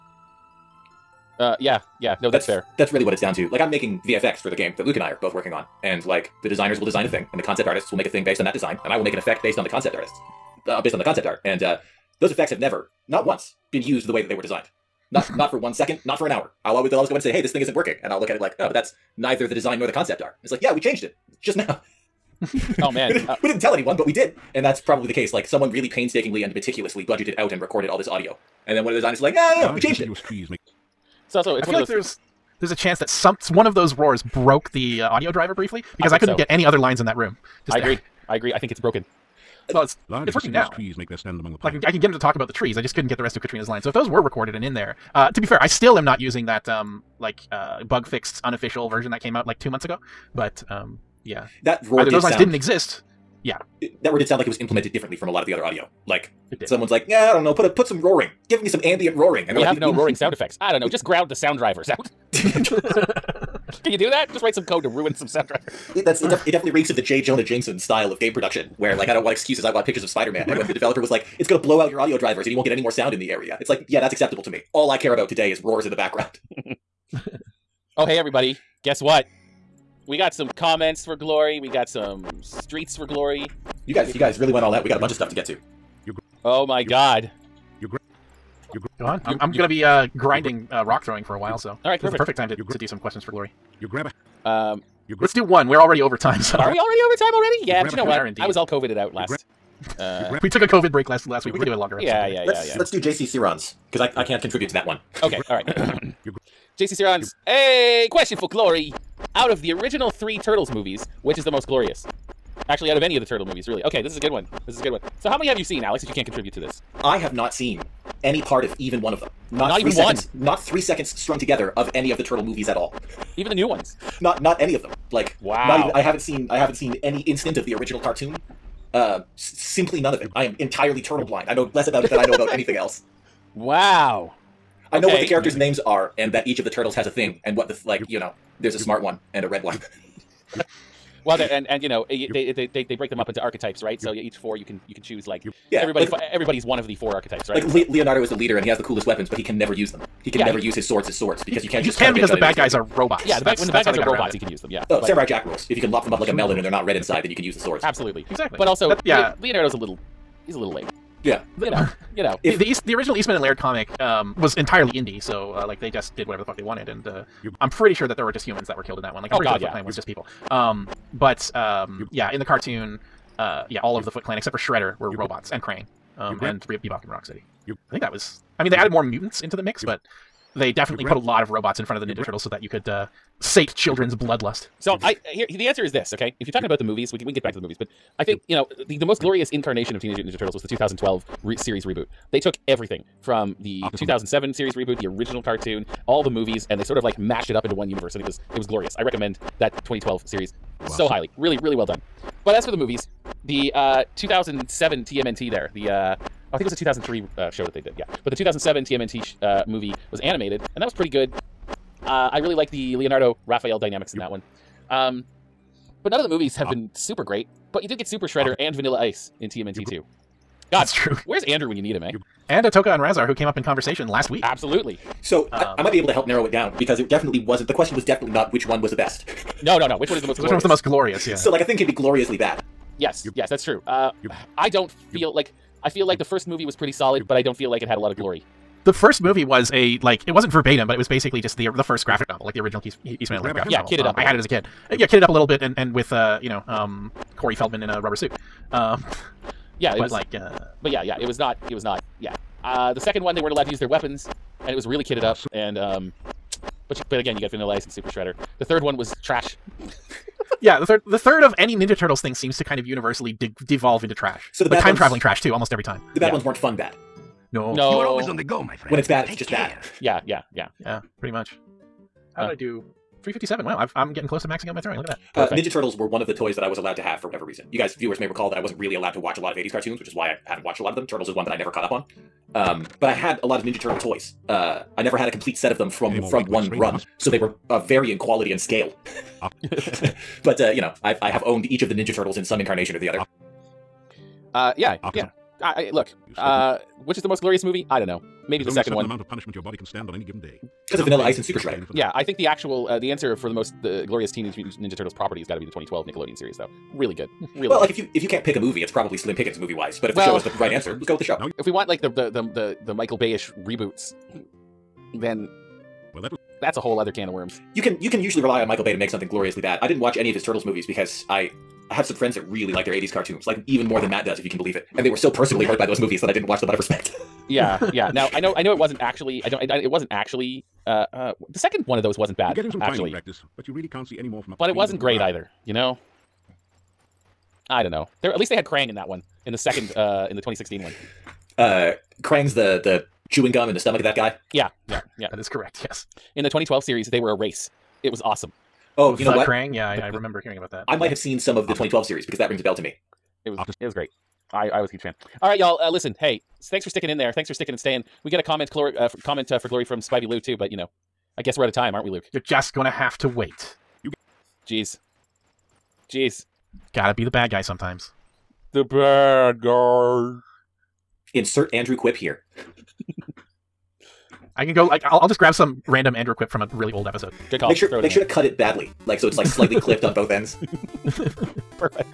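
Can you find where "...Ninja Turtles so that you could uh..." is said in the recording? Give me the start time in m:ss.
3:02.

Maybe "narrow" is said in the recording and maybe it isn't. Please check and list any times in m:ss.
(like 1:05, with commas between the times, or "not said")
3:46.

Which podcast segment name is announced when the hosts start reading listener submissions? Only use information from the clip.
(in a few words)
questions for glory.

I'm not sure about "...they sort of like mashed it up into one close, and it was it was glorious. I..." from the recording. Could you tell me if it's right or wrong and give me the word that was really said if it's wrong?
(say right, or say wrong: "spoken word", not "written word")
wrong: "universe", not "close".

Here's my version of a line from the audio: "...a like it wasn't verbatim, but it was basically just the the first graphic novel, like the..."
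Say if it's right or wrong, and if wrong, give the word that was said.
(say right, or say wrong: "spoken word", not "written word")
right.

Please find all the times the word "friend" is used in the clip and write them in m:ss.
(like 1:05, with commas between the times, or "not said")
4:28, 5:22.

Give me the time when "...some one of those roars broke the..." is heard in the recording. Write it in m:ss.
0:33.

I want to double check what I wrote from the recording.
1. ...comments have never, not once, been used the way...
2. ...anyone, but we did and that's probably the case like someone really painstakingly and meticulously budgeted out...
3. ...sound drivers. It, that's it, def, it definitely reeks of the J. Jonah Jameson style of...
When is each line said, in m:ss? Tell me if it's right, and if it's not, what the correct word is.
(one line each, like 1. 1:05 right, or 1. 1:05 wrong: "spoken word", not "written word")
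1. 0:12 wrong: "effects", not "comments"
2. 0:23 right
3. 1:05 right.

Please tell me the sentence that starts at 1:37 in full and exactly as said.
Yeah, you but you know what?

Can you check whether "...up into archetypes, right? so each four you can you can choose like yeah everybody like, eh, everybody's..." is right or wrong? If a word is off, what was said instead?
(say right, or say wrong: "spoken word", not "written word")
right.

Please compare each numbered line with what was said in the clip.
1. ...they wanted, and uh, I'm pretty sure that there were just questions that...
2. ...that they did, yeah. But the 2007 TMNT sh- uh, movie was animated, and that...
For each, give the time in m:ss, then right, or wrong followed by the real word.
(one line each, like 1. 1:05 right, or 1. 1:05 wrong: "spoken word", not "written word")
1. 2:46 wrong: "humans", not "questions"
2. 3:27 right.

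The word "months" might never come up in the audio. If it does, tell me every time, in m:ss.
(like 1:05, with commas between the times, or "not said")
0:49.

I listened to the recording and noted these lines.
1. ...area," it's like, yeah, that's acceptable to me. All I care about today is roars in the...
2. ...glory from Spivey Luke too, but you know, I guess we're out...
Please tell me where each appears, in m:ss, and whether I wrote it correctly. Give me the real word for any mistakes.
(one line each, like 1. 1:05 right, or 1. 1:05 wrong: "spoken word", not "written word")
1. 1:13 right
2. 5:59 wrong: "Lou", not "Luke".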